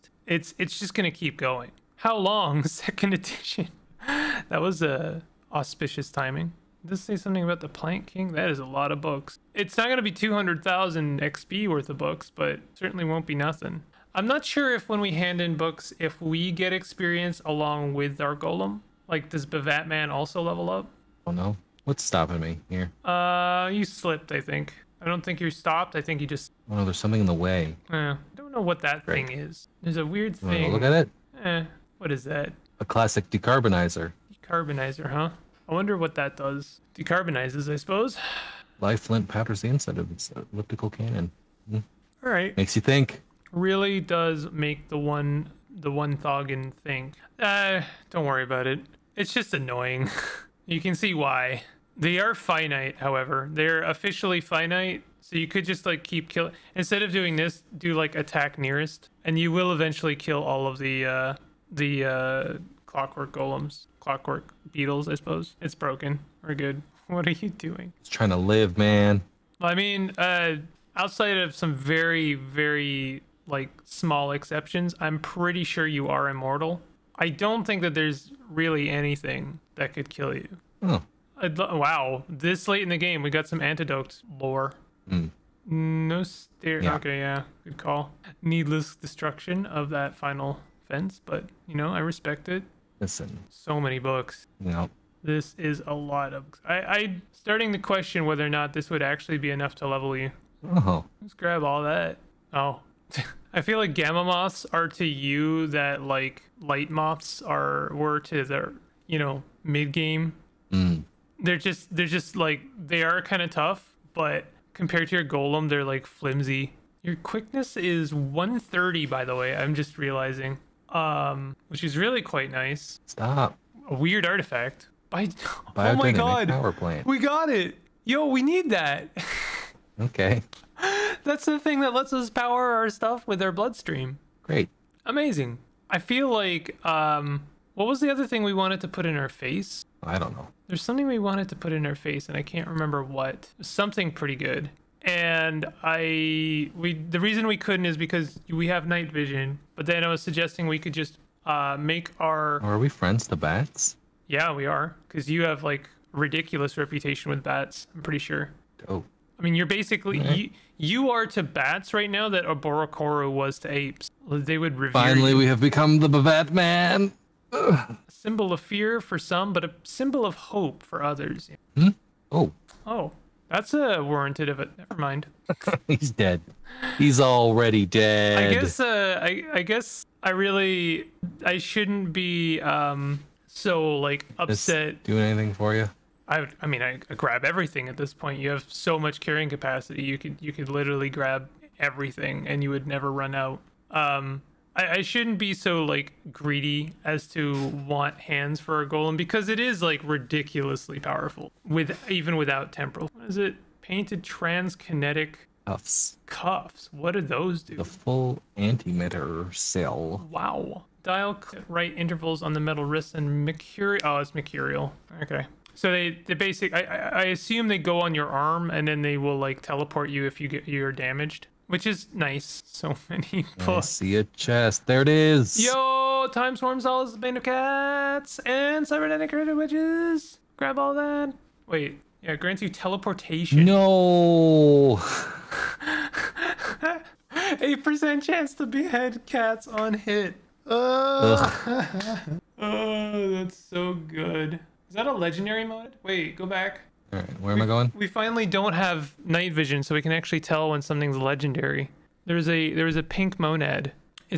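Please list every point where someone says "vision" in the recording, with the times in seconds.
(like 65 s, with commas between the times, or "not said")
149 s, 249 s.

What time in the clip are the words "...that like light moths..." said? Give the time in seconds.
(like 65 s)
105 s.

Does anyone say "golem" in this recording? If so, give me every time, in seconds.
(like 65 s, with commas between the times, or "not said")
18 s, 63 s, 115 s, 198 s.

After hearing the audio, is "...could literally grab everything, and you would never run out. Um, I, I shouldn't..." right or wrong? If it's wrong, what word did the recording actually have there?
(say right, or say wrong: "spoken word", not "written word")
right.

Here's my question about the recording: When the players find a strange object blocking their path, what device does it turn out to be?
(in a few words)
Classic decarbonizer.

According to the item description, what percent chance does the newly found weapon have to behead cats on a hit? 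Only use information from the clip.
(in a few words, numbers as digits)
8%.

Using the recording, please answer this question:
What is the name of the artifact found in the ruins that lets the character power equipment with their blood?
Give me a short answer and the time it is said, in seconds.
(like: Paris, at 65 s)
Power plant, at 126 s.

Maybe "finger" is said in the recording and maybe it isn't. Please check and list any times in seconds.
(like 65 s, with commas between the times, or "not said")
not said.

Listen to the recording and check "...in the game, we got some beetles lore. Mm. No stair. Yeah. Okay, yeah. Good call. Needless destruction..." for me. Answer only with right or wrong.
wrong.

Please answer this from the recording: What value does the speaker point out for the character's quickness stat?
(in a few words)
130.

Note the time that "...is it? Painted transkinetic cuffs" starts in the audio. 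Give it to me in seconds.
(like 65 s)
203 s.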